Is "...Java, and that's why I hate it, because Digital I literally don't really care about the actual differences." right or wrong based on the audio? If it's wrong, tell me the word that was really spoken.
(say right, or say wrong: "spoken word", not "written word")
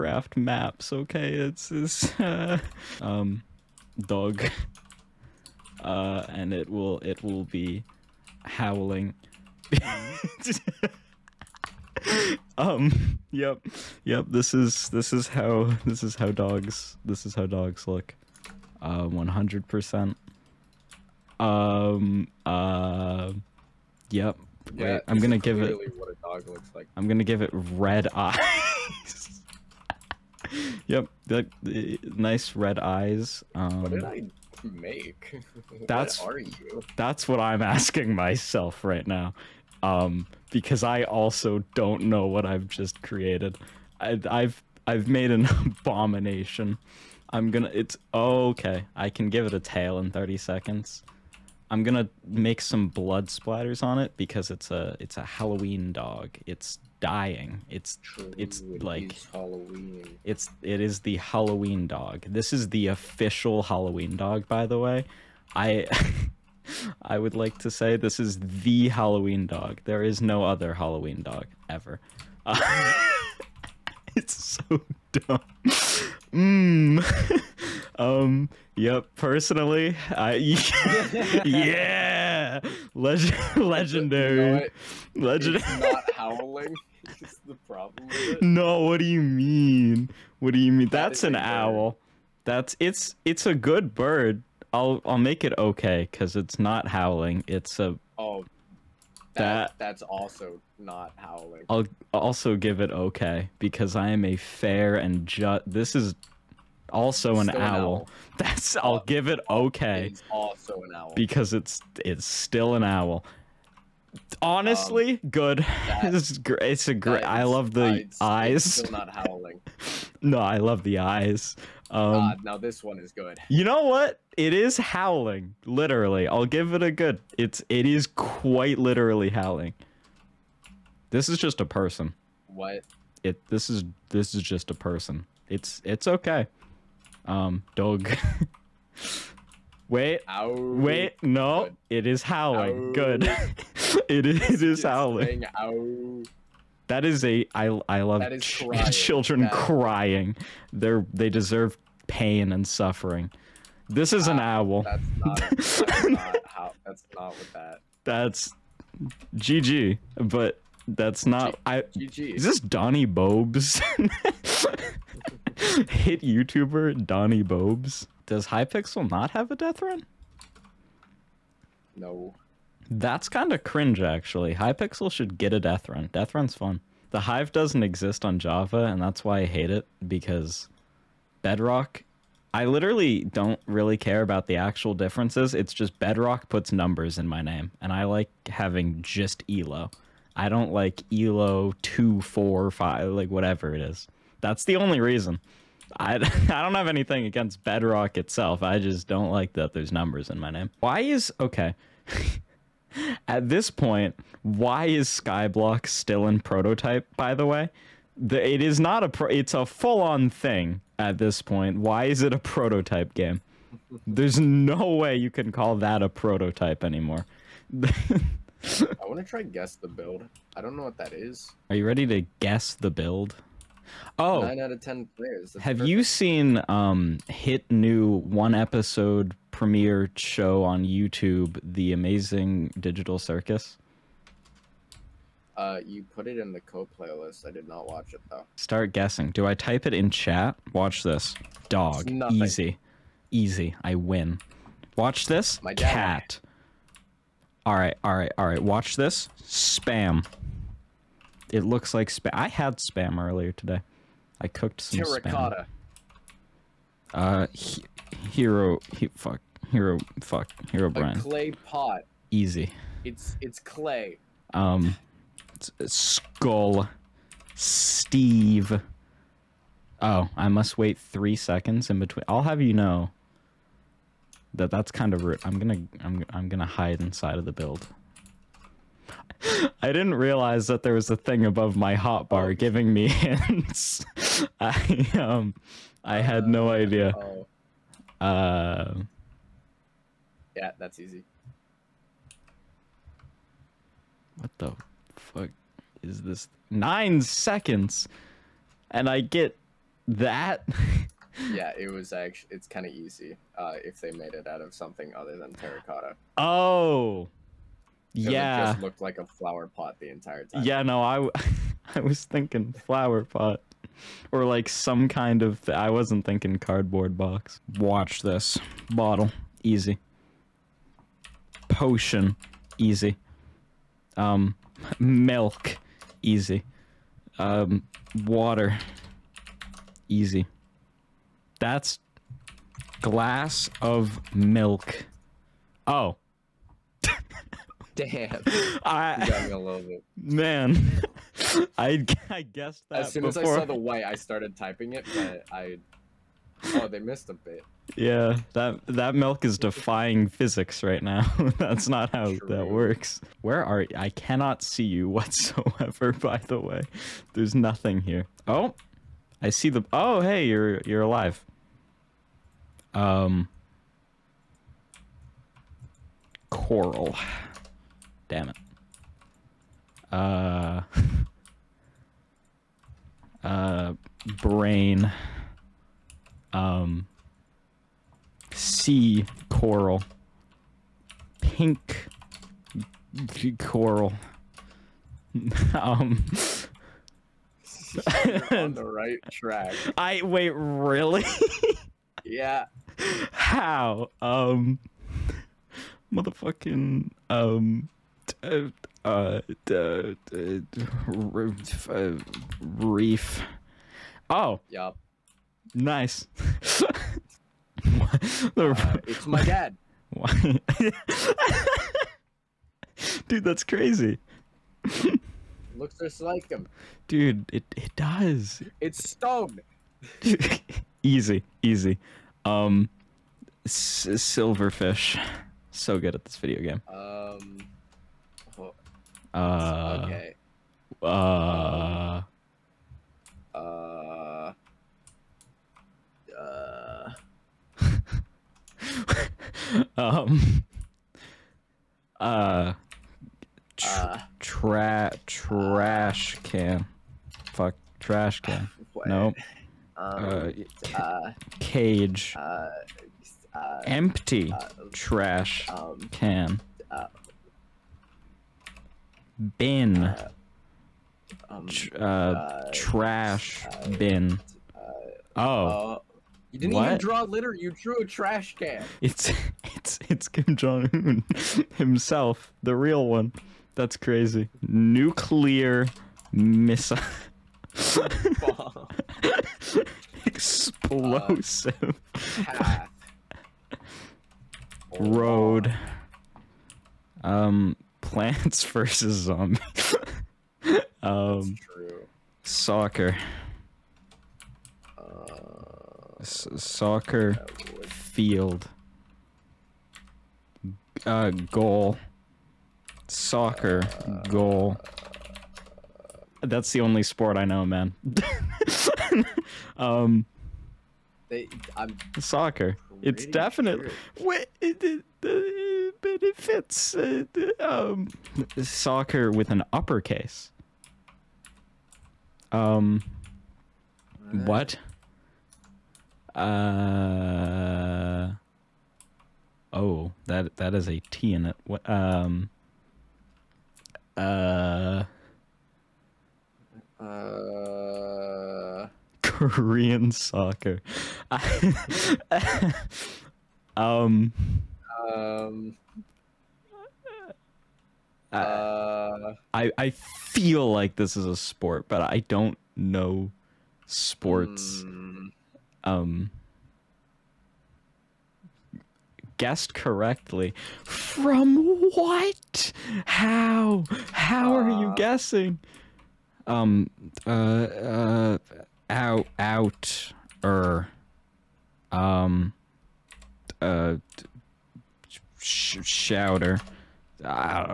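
wrong: "Bedrock", not "Digital".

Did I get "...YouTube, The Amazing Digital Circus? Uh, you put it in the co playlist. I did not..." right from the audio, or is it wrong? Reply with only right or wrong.
right.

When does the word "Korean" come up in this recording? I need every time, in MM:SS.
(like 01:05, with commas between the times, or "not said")
08:59.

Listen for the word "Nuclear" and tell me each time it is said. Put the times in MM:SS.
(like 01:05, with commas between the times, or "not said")
07:54.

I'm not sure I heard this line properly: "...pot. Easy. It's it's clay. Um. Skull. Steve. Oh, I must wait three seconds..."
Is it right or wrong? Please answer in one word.
right.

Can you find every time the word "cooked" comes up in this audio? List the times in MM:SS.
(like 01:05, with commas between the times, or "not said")
04:14.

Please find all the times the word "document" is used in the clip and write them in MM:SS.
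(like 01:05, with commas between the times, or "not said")
not said.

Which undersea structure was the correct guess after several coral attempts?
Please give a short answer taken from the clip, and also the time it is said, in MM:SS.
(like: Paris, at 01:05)
reef, at 06:42.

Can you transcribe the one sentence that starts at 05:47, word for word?
Yeah, that that milk is defying physics right now.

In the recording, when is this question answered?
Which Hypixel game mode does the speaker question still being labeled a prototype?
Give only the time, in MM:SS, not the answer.
03:25.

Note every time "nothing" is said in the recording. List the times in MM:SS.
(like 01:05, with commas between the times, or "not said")
05:57.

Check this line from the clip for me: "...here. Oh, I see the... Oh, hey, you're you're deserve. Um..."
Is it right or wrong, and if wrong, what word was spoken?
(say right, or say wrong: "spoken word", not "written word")
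wrong: "alive", not "deserve".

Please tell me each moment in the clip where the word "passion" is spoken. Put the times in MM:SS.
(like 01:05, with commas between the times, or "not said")
not said.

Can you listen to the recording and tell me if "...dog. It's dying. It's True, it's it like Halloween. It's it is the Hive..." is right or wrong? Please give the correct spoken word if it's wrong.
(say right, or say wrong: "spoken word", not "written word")
wrong: "Halloween", not "Hive".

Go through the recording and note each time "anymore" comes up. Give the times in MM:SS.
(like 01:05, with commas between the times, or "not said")
03:36.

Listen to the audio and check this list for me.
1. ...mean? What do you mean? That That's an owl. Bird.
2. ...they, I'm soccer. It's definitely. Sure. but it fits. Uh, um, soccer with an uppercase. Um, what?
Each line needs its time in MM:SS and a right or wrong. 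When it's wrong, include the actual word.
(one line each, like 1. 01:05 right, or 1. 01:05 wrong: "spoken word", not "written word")
1. 01:29 right
2. 08:31 right.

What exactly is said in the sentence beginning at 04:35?
I'm gonna I'm I'm gonna hide inside of the build.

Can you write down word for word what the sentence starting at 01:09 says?
There is no other Halloween dog ever.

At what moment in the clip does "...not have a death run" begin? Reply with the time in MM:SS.
02:49.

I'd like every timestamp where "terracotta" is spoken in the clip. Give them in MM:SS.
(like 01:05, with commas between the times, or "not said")
04:15, 05:05.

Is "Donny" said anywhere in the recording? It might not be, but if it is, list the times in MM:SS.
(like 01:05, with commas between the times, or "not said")
02:42, 02:47.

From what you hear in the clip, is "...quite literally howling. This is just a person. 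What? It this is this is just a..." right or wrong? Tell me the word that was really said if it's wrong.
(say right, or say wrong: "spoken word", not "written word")
right.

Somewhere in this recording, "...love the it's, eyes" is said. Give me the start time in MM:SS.
01:57.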